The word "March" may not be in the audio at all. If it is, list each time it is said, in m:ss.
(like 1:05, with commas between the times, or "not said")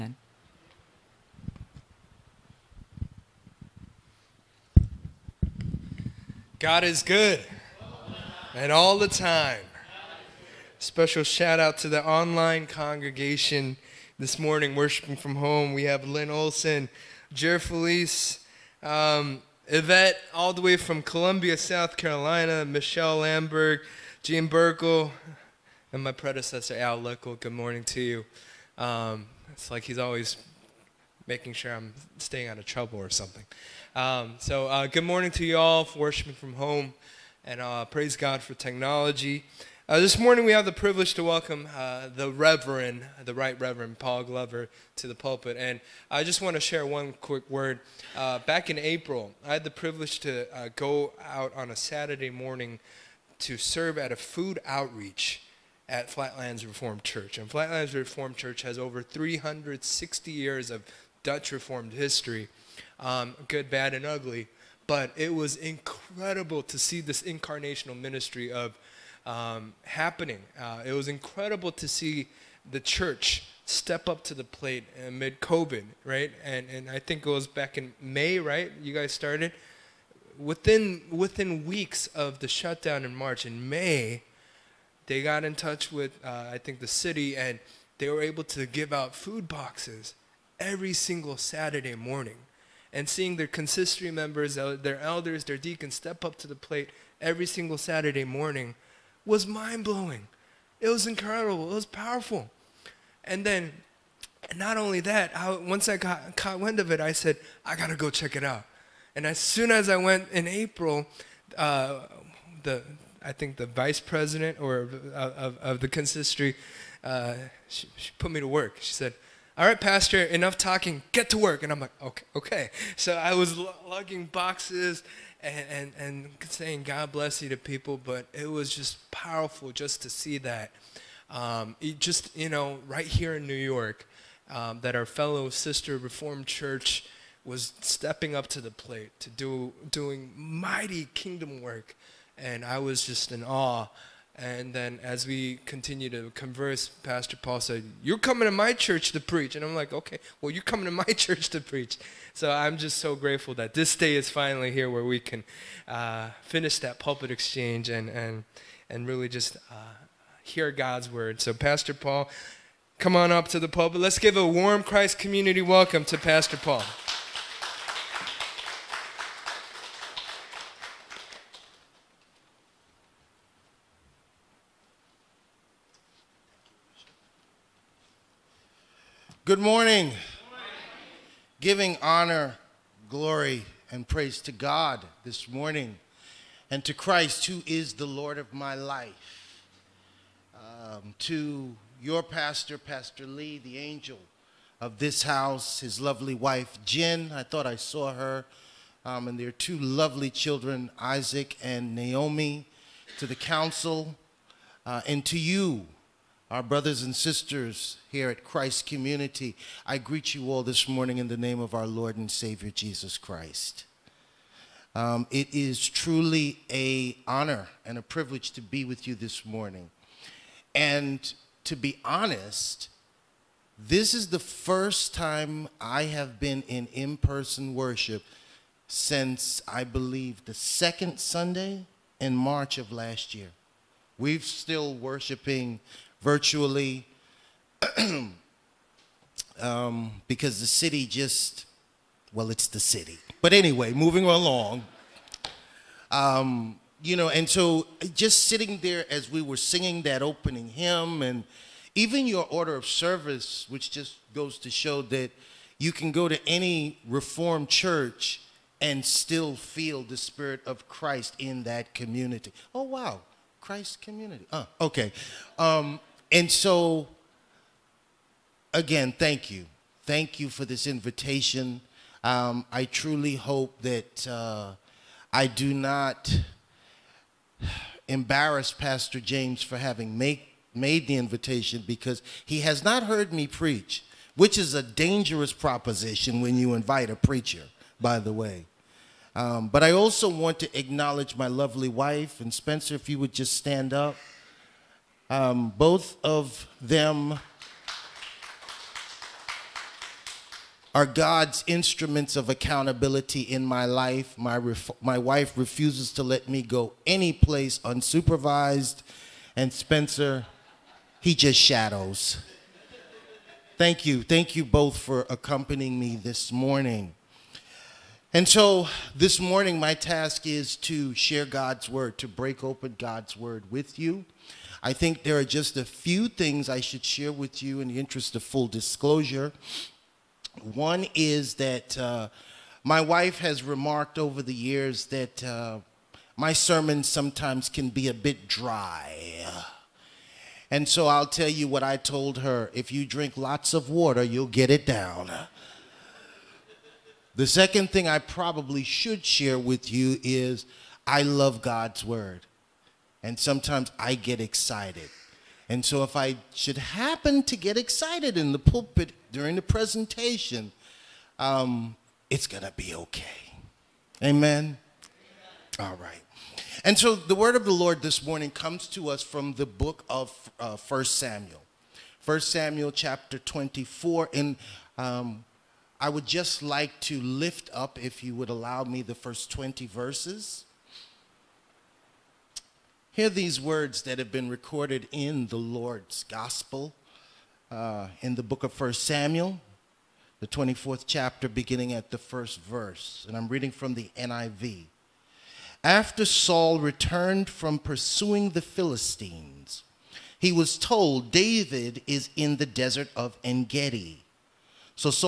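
1:23, 3:52.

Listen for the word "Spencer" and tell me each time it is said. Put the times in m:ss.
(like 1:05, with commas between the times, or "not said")
4:52, 5:09.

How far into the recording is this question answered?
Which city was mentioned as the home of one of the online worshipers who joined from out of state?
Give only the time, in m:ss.
0:21.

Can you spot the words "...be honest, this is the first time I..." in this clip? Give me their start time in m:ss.
3:41.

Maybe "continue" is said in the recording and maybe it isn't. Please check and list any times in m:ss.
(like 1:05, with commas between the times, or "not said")
2:25.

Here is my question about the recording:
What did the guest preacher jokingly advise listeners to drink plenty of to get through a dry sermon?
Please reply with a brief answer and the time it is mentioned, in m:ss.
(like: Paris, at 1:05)
water, at 5:43.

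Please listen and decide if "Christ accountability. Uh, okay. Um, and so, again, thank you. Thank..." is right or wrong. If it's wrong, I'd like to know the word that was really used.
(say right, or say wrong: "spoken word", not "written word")
wrong: "community", not "accountability".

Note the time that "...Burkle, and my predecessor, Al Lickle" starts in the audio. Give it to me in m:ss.
0:24.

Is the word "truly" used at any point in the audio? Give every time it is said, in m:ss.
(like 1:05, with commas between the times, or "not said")
3:35, 4:32.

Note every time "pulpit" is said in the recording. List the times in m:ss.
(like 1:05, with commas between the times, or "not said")
0:45, 2:36, 2:43, 5:58.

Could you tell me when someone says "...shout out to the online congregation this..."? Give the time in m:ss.
0:11.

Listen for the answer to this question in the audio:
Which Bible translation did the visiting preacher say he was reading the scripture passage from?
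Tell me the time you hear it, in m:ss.
6:34.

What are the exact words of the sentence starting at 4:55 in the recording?
Um, both of them are God's instruments of accountability in my life.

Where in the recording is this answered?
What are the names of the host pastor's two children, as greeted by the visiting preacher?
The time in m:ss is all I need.
3:20.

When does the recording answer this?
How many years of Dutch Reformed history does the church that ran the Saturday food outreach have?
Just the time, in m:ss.
0:58.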